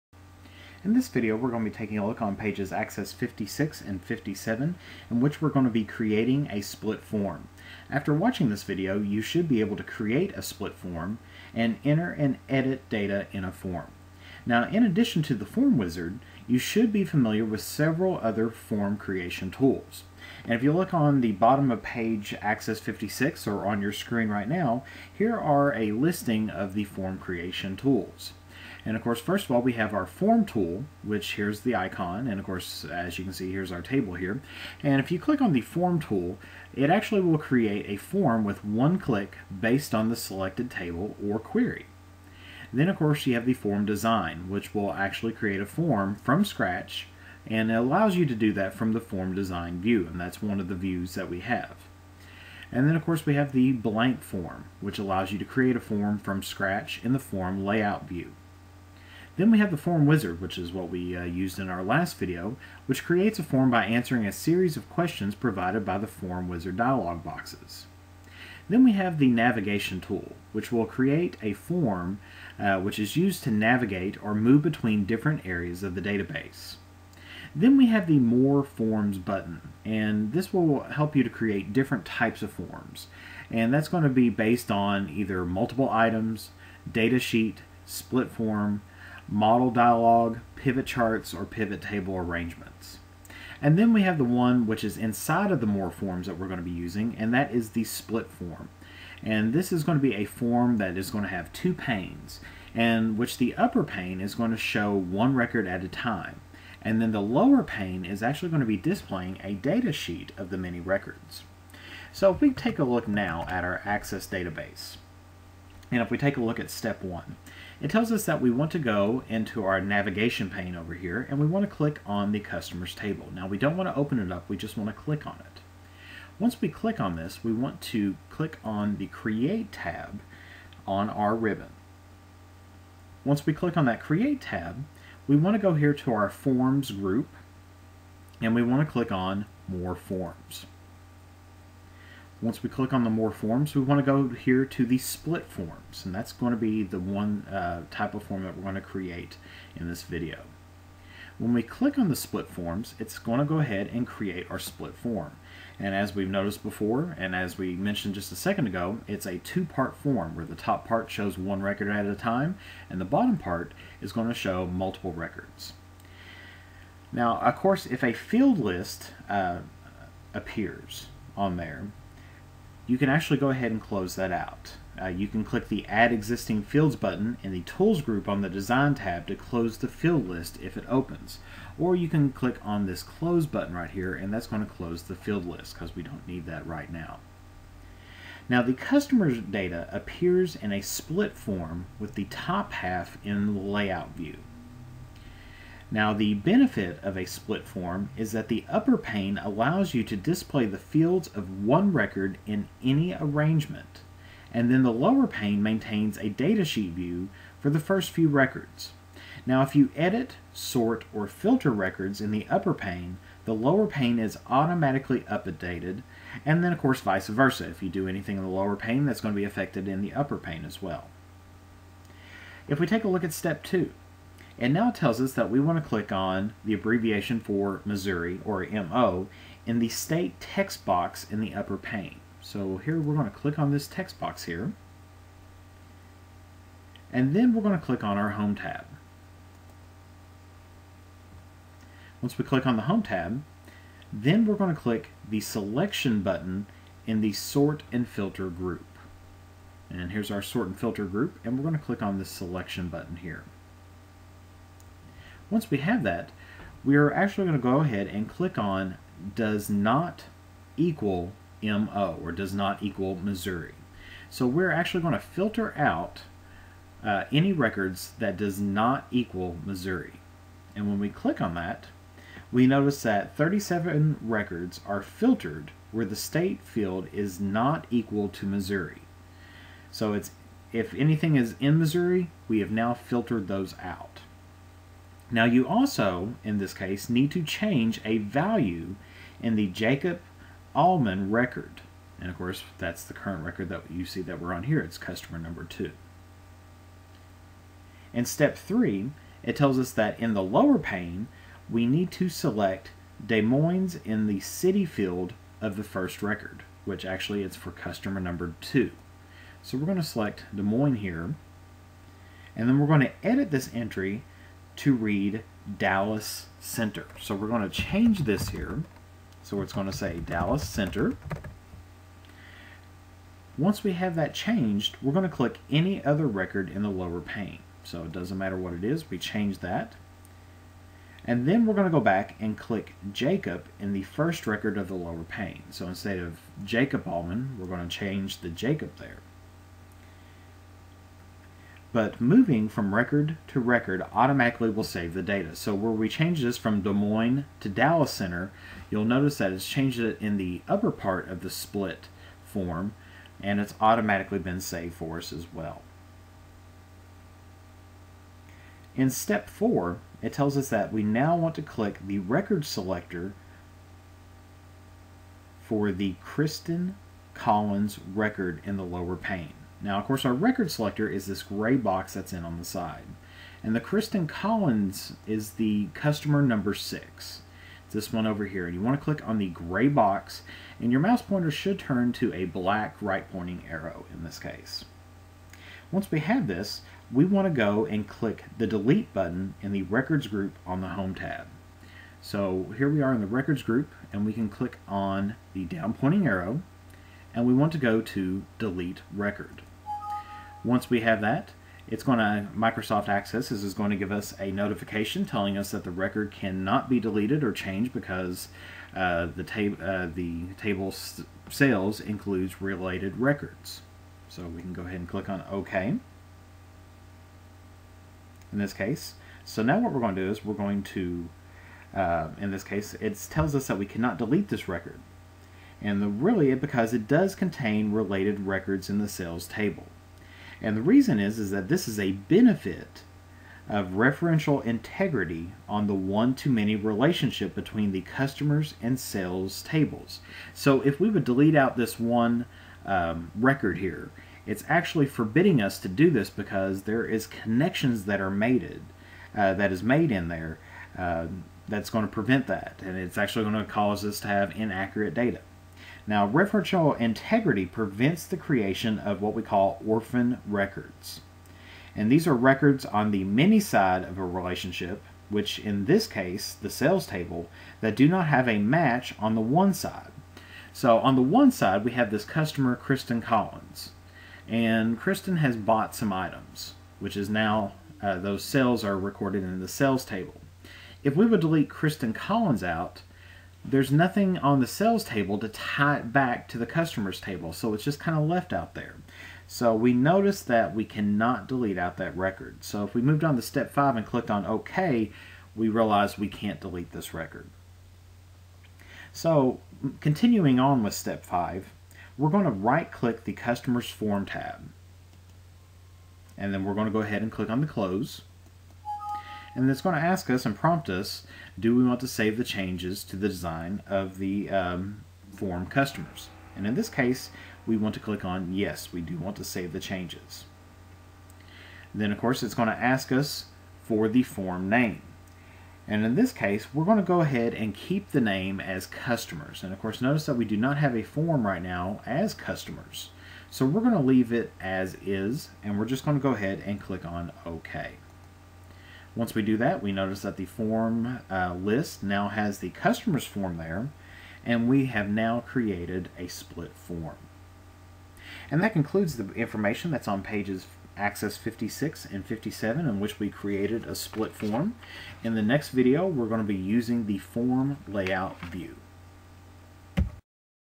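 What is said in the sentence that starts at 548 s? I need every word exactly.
And that concludes the information that's on pages Access 56 and 57 in which we created a split form.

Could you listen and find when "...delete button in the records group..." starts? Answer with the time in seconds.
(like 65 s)
388 s.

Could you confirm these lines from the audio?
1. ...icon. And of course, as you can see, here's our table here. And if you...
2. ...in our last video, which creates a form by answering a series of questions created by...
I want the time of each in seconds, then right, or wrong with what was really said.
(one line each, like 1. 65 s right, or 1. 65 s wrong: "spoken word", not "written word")
1. 31 s right
2. 61 s wrong: "provided", not "created".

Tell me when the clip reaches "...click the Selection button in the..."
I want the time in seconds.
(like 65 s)
244 s.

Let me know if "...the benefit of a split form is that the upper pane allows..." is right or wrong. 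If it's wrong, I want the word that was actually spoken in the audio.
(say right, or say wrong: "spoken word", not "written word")
right.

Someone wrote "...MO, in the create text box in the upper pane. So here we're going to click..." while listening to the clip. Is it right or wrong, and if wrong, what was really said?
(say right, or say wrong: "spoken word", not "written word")
wrong: "state", not "create".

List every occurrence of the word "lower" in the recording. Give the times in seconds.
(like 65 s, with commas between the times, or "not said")
107 s, 204 s, 213 s, 218 s, 300 s, 326 s, 334 s, 368 s.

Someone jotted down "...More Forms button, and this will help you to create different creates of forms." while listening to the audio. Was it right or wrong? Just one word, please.
wrong.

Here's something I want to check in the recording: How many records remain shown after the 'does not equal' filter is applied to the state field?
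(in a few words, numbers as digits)
37.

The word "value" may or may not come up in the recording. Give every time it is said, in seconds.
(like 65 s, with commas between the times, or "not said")
288 s.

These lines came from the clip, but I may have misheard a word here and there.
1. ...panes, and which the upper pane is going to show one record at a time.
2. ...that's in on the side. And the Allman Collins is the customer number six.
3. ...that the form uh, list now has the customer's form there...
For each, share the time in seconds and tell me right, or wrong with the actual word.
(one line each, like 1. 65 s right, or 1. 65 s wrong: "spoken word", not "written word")
1. 101 s right
2. 372 s wrong: "Kristen", not "Allman"
3. 540 s right.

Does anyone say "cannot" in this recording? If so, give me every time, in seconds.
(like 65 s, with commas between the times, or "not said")
406 s, 423 s, 490 s.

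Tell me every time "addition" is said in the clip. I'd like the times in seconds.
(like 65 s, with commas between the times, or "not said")
14 s.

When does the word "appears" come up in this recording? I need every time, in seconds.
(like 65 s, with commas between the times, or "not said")
170 s, 189 s.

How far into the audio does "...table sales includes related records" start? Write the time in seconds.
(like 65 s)
410 s.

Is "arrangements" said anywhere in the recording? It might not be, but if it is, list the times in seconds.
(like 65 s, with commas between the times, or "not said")
92 s, 203 s.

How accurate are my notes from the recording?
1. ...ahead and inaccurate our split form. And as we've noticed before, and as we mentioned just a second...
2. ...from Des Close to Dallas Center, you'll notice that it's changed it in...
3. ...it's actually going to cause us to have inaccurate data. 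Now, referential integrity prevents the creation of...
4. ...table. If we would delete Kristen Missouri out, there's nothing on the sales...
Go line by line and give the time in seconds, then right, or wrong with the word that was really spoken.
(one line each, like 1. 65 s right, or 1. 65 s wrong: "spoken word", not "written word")
1. 153 s wrong: "create", not "inaccurate"
2. 346 s wrong: "Moines", not "Close"
3. 452 s right
4. 480 s wrong: "Collins", not "Missouri".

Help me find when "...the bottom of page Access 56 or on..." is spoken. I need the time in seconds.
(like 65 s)
21 s.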